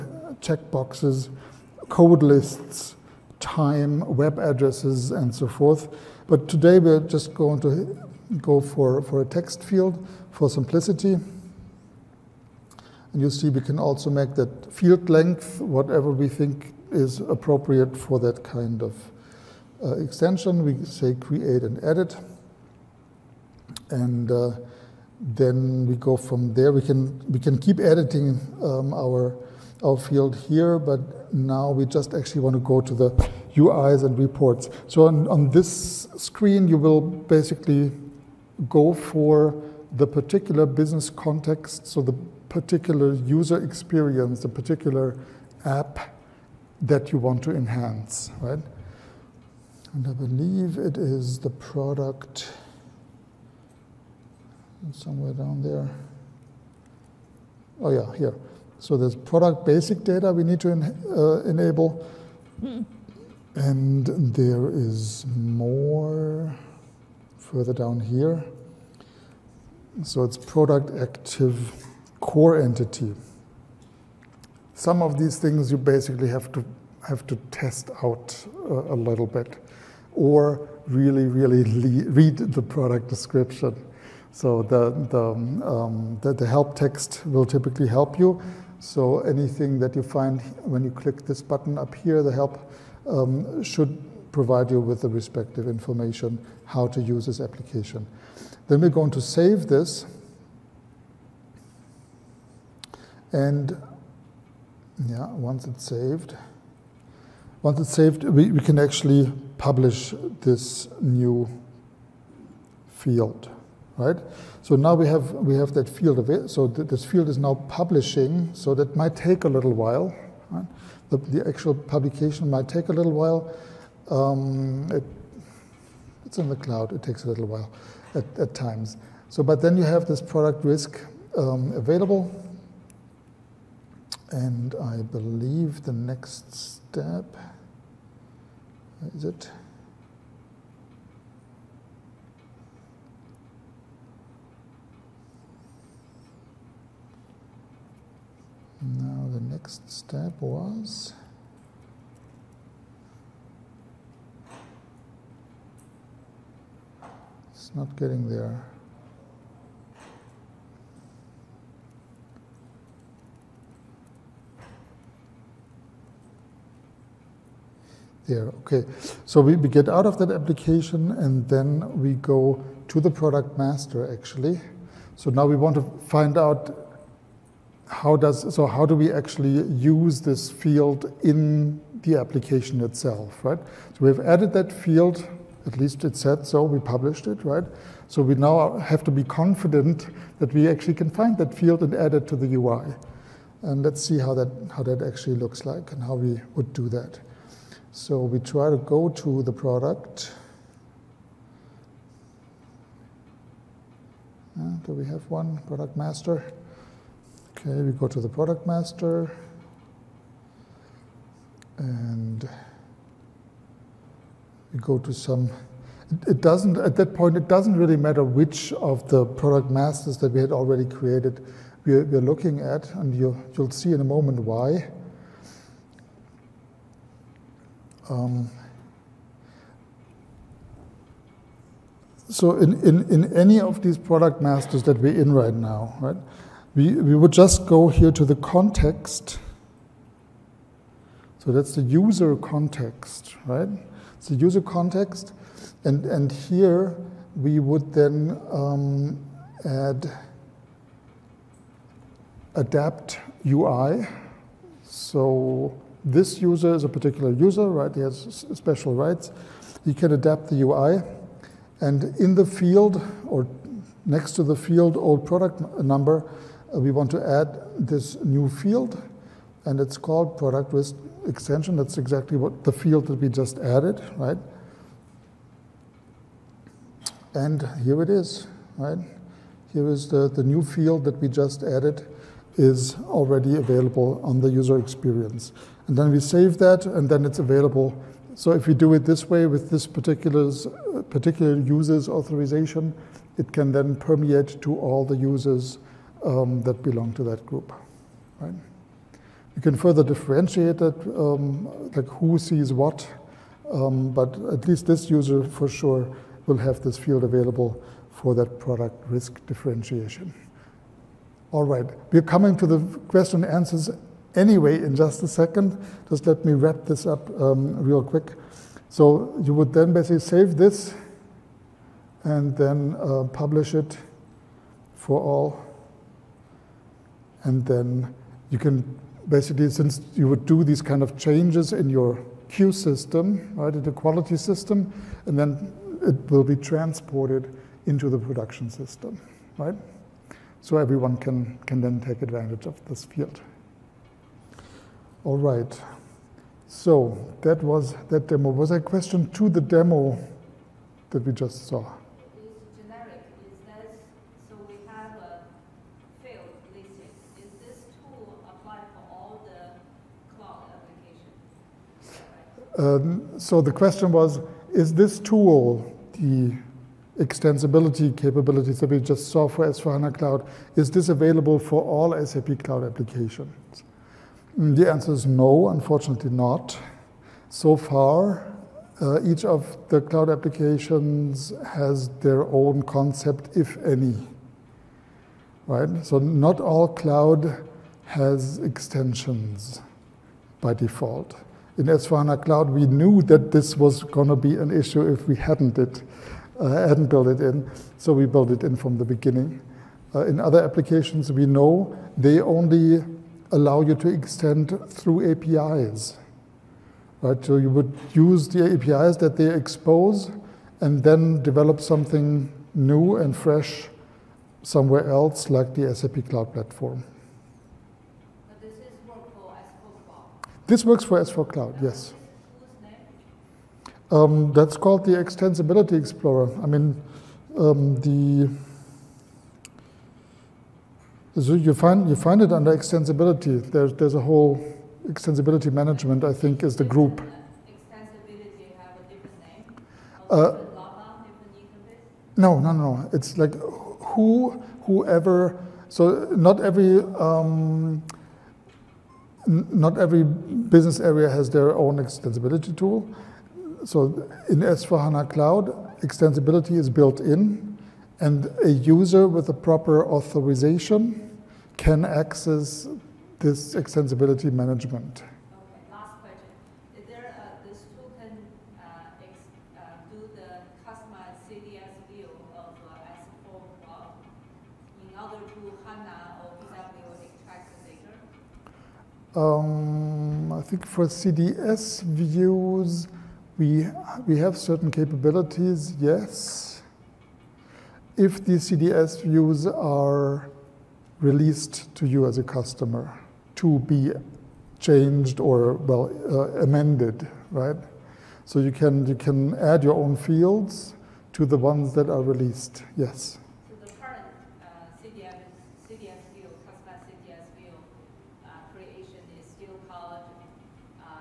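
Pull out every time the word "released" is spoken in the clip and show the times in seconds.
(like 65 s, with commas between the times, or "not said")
491 s, 502 s.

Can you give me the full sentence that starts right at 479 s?
Um, I think for CDS views, we, we have certain capabilities, yes.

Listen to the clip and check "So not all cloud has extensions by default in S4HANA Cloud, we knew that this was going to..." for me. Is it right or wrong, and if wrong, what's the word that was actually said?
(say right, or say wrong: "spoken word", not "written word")
right.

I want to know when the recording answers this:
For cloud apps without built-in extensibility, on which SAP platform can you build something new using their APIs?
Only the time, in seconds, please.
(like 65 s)
415 s.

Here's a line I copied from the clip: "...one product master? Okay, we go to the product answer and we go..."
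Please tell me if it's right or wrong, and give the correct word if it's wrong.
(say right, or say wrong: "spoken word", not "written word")
wrong: "master", not "answer".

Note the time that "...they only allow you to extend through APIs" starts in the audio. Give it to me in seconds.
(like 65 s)
402 s.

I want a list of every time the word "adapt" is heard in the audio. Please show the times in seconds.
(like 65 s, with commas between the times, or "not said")
252 s, 260 s.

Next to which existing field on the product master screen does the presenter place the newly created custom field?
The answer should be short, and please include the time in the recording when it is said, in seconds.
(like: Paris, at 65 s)
old product number, at 264 s.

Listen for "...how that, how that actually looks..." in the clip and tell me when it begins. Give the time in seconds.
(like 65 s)
194 s.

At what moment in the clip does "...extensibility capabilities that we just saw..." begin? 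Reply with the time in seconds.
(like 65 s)
367 s.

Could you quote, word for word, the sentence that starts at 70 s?
So it's product active core entity.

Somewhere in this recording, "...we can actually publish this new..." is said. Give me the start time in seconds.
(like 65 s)
108 s.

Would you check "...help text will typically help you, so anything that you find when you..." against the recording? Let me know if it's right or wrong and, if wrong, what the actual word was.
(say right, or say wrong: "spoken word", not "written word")
right.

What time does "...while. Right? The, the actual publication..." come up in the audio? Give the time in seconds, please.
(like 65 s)
119 s.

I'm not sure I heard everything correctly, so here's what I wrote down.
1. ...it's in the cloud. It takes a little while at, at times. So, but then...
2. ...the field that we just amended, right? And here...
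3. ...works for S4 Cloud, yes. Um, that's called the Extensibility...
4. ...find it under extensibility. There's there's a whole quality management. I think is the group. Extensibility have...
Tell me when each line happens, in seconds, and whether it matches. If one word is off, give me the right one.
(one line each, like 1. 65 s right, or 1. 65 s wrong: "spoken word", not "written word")
1. 126 s right
2. 272 s wrong: "added", not "amended"
3. 420 s right
4. 432 s wrong: "extensibility", not "quality".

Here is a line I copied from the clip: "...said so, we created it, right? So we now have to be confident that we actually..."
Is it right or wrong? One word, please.
wrong.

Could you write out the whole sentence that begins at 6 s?
But today we're just going to go for, for a text field for simplicity.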